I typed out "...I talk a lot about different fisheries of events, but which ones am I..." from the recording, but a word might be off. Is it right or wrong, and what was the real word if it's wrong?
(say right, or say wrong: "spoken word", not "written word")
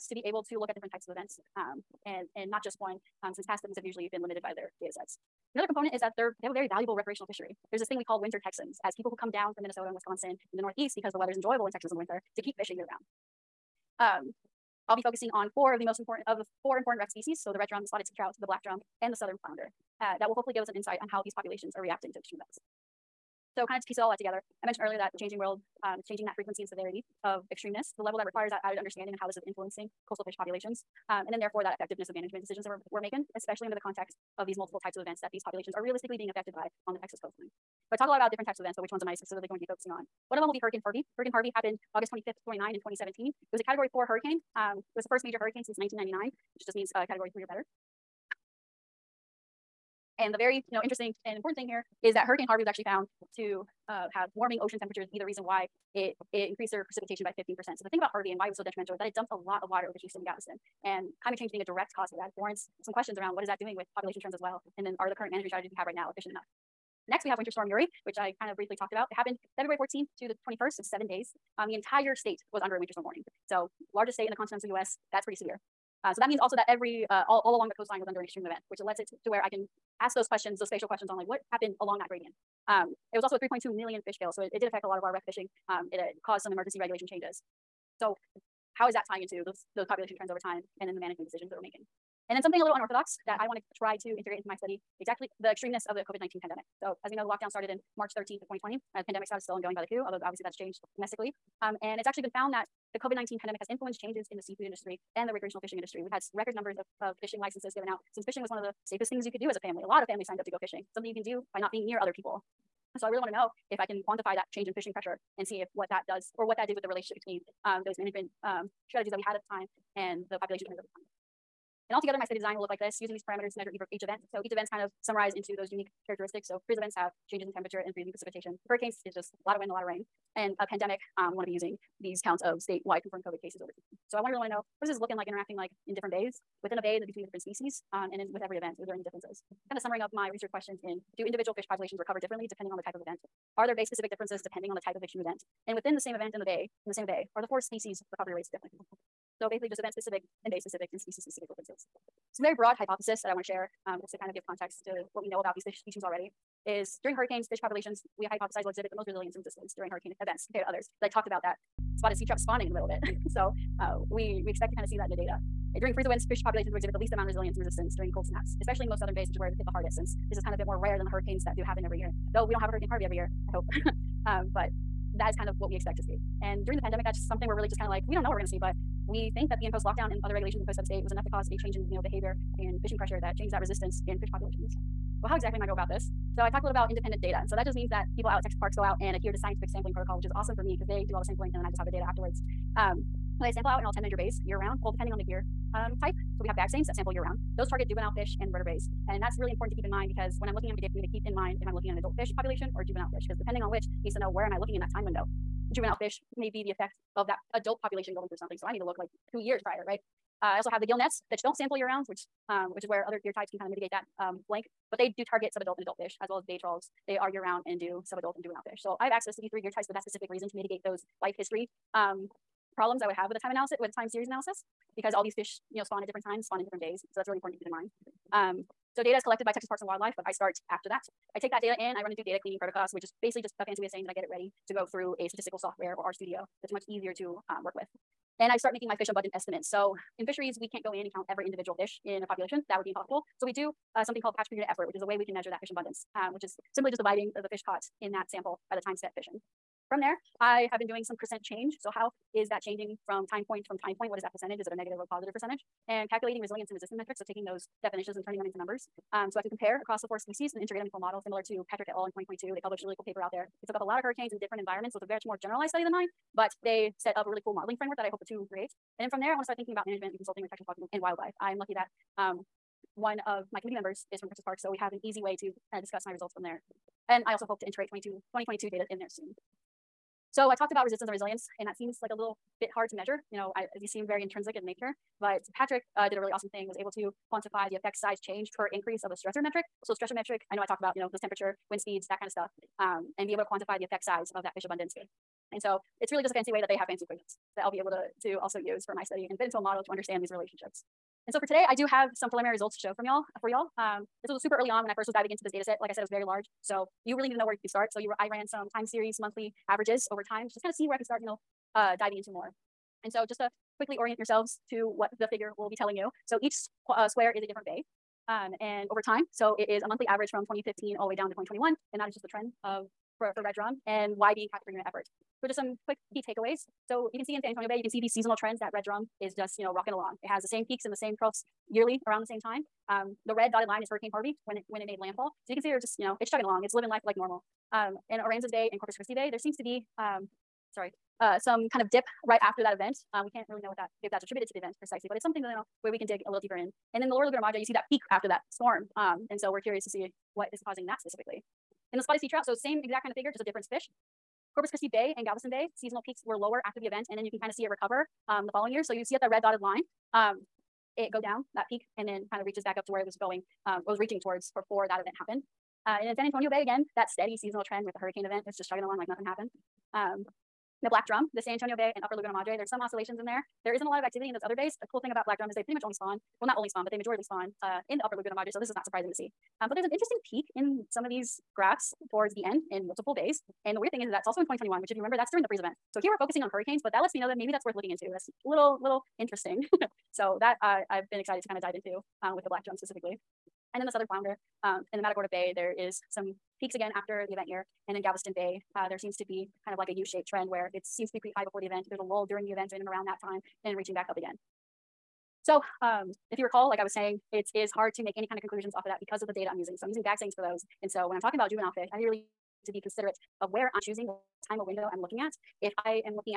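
wrong: "types", not "fisheries".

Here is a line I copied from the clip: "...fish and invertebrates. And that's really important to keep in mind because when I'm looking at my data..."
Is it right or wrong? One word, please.
right.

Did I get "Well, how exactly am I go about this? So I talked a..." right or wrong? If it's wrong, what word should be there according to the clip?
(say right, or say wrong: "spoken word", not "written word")
right.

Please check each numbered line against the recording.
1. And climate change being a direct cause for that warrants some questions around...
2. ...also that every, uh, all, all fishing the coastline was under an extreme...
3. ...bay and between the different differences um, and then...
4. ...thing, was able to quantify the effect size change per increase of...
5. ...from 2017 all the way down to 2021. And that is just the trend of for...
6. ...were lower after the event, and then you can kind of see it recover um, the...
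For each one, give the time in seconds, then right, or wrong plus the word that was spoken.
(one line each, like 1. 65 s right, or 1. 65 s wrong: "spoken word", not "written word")
1. 60 s right
2. 76 s wrong: "along", not "fishing"
3. 136 s wrong: "species", not "differences"
4. 286 s right
5. 320 s wrong: "2015", not "2017"
6. 356 s right.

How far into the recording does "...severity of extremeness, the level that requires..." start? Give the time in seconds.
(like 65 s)
26 s.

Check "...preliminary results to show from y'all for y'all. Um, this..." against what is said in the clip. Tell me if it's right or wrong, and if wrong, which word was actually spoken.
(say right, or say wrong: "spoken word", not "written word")
right.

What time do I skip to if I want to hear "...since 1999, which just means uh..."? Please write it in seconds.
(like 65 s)
45 s.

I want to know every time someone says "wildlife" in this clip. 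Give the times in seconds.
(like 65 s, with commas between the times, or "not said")
229 s, 271 s.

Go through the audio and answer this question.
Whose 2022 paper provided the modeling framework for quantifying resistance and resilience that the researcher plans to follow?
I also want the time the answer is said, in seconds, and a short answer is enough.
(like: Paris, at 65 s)
Patrick et al., at 261 s.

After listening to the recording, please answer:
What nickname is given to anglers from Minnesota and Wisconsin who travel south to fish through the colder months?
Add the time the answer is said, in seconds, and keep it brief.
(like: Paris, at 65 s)
Winter Texans, at 8 s.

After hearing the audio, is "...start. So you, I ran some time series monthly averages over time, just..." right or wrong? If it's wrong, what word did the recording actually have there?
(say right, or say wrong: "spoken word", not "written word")
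right.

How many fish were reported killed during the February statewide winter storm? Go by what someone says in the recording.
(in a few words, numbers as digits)
3.2 million.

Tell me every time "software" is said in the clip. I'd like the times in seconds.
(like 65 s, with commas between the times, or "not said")
235 s.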